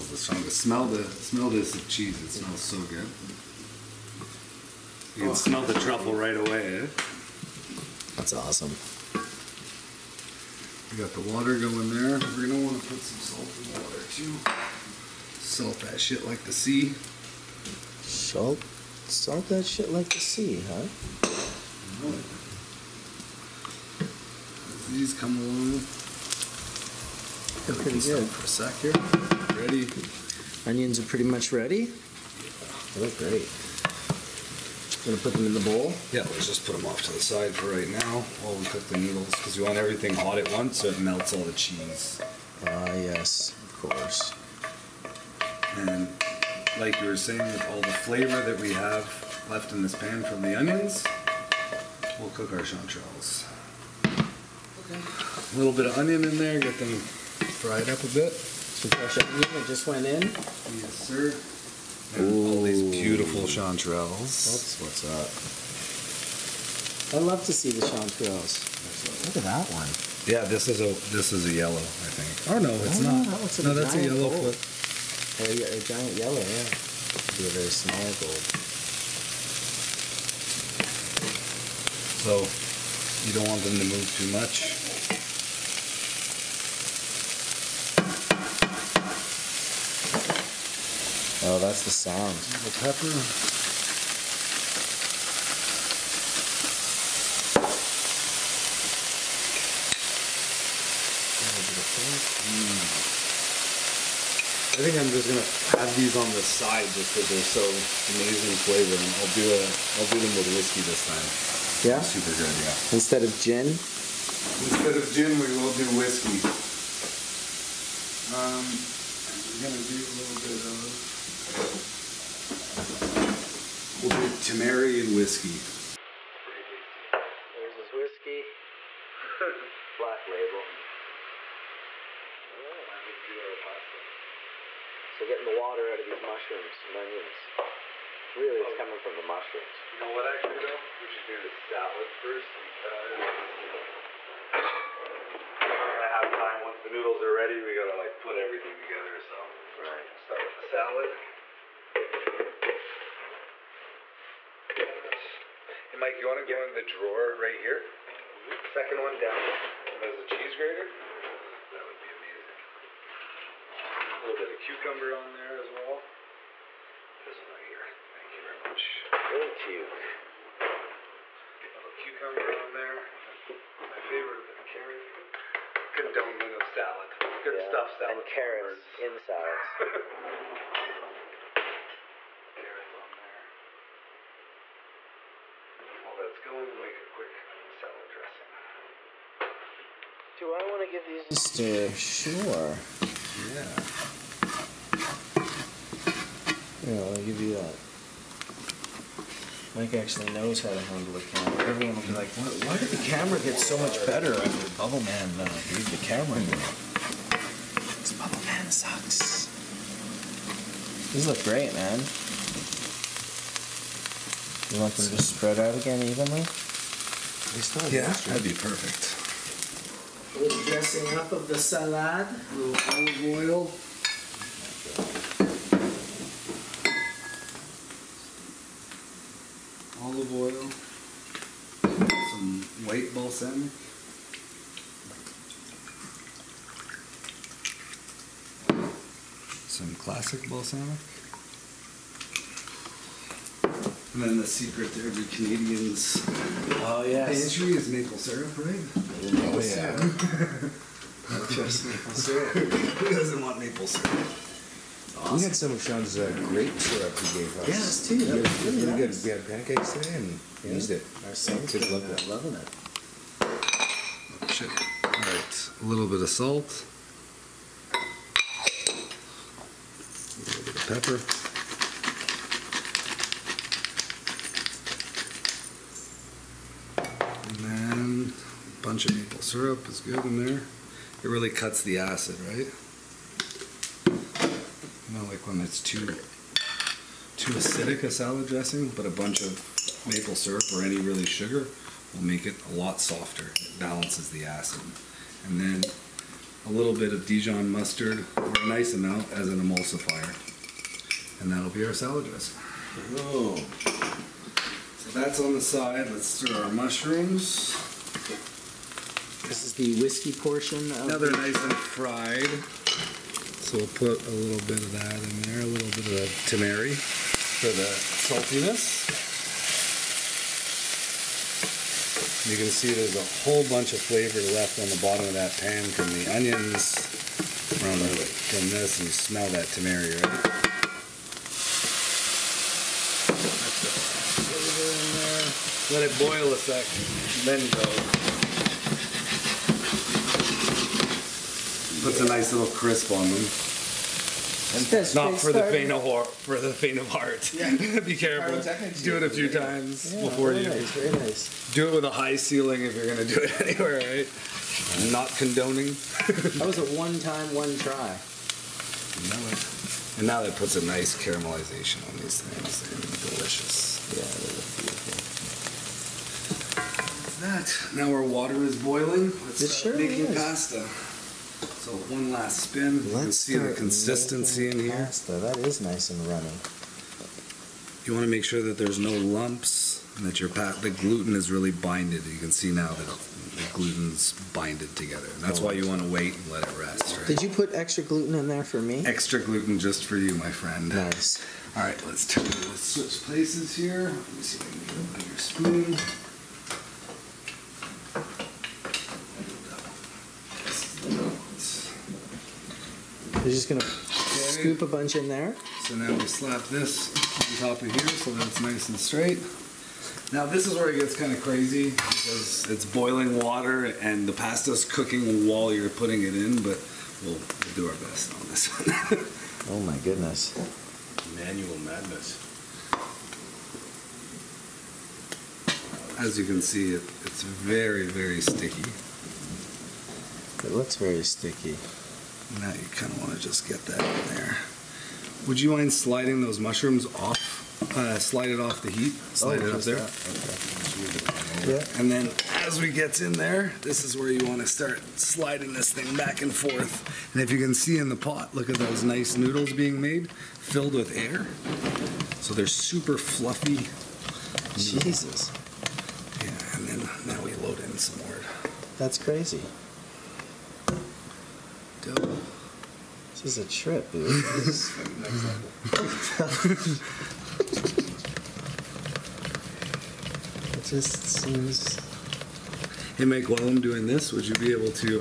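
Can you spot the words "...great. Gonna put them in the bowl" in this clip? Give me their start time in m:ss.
0:33.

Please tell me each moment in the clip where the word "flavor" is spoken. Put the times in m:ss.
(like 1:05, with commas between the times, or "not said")
0:47, 1:48, 5:23.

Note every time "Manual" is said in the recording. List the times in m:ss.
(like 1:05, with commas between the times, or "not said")
7:01.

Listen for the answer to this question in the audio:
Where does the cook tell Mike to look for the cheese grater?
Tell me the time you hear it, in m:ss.
2:38.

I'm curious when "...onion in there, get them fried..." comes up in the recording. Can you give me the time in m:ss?
0:55.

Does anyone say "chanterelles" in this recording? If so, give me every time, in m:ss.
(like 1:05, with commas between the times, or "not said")
0:52, 1:03, 1:07.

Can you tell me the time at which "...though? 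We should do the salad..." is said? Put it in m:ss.
2:20.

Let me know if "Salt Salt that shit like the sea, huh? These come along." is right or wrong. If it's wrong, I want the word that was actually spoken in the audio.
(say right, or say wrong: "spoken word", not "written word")
right.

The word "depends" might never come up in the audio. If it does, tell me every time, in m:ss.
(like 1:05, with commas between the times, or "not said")
not said.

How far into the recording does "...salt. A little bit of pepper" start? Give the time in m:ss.
4:26.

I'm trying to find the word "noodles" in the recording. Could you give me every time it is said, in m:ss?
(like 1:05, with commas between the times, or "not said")
0:38, 2:26, 7:29.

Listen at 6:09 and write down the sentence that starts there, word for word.
Let's it start sure making is.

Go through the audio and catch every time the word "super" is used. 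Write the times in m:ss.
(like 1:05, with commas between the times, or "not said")
1:51, 7:32.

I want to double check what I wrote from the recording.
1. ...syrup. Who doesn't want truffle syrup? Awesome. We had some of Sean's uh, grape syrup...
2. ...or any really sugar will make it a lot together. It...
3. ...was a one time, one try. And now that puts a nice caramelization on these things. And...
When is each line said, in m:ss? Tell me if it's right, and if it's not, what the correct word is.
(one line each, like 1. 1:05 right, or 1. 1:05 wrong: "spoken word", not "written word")
1. 4:12 wrong: "maple", not "truffle"
2. 4:50 wrong: "softer", not "together"
3. 5:56 right.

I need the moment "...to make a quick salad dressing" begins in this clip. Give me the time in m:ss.
3:06.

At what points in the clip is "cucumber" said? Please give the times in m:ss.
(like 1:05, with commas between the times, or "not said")
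2:44, 2:51.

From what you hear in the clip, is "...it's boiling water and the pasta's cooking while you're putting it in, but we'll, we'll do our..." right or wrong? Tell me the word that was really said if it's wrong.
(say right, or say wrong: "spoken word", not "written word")
right.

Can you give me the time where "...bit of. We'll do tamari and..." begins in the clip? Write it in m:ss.
2:00.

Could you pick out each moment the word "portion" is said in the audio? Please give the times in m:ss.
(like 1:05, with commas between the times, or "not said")
5:10.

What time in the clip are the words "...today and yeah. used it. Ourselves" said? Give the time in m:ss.
4:19.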